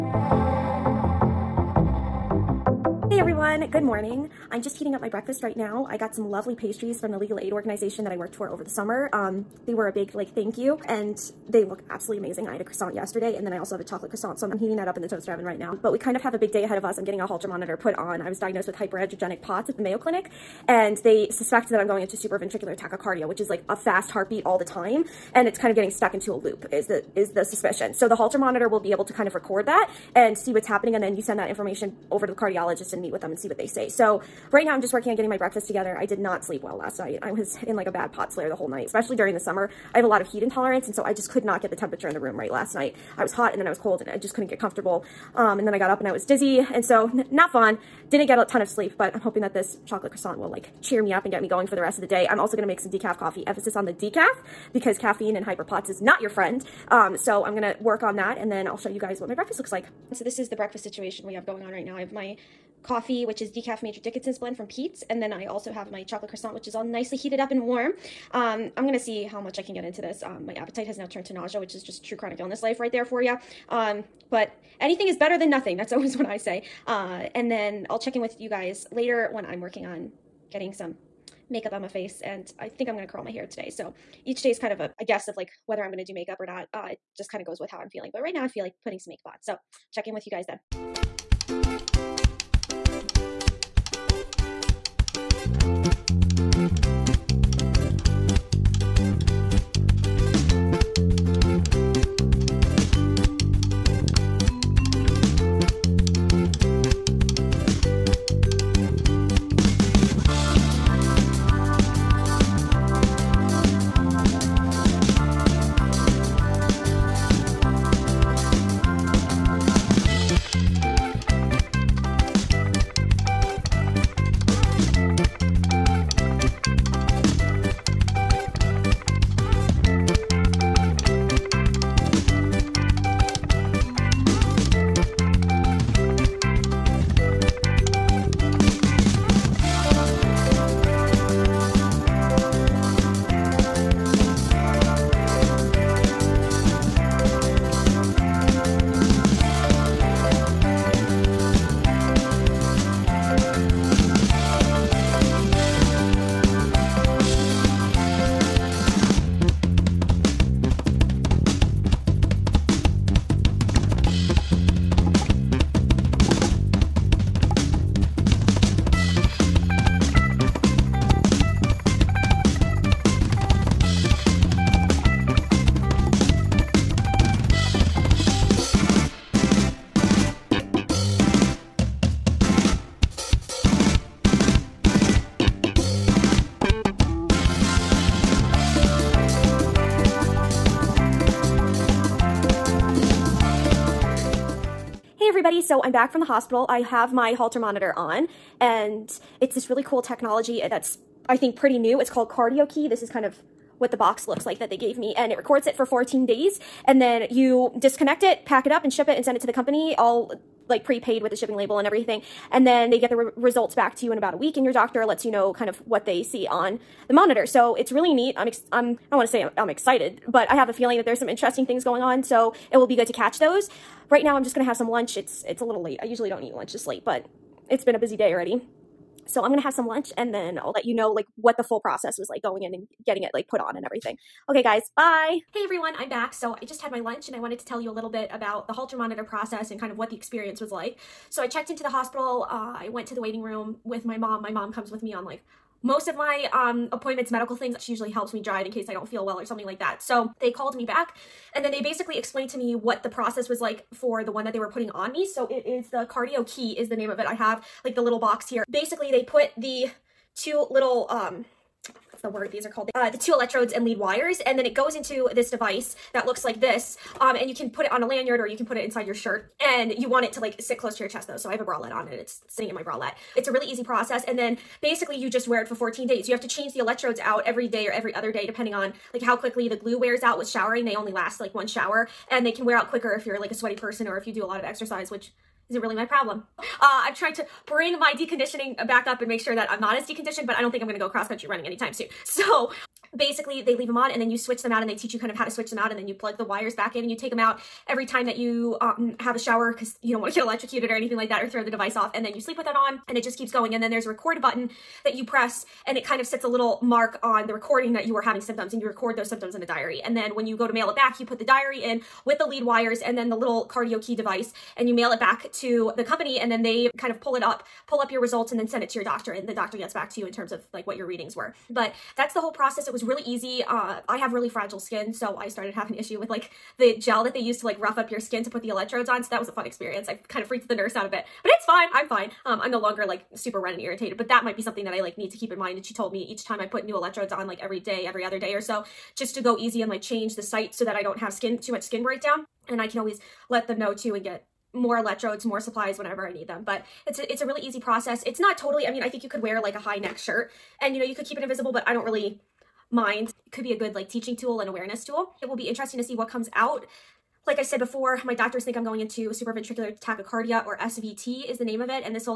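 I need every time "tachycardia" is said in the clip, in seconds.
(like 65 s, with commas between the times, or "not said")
22 s, 359 s.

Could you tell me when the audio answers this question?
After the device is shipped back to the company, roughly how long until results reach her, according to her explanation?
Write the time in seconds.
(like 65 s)
214 s.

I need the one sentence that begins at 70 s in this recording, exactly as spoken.
Um, my appetite has now turned to nausea, which is just true chronic illness life right there for you.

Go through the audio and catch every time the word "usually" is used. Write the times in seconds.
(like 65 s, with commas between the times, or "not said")
226 s, 247 s.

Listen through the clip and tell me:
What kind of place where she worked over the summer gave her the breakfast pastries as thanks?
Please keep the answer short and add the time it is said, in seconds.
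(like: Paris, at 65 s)
Legal aid organization, at 7 s.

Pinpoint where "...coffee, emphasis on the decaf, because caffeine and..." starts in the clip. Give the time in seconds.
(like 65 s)
53 s.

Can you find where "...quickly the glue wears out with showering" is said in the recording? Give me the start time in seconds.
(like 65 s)
279 s.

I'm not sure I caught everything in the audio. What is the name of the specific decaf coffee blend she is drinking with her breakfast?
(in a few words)
Major Dickason's.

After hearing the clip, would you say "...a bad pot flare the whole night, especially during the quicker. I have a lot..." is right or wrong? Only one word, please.
wrong.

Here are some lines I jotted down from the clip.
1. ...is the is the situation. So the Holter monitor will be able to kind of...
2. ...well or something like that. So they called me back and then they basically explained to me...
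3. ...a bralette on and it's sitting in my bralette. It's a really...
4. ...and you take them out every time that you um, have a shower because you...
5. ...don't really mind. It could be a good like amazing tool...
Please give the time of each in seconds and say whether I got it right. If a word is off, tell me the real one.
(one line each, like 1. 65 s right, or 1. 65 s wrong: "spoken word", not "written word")
1. 26 s wrong: "suspicion", not "situation"
2. 249 s right
3. 271 s right
4. 297 s right
5. 351 s wrong: "teaching", not "amazing".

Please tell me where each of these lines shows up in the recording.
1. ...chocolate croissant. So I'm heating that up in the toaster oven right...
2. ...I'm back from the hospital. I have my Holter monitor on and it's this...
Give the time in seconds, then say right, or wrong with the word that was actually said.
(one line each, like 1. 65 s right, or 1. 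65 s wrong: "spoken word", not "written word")
1. 13 s right
2. 195 s right.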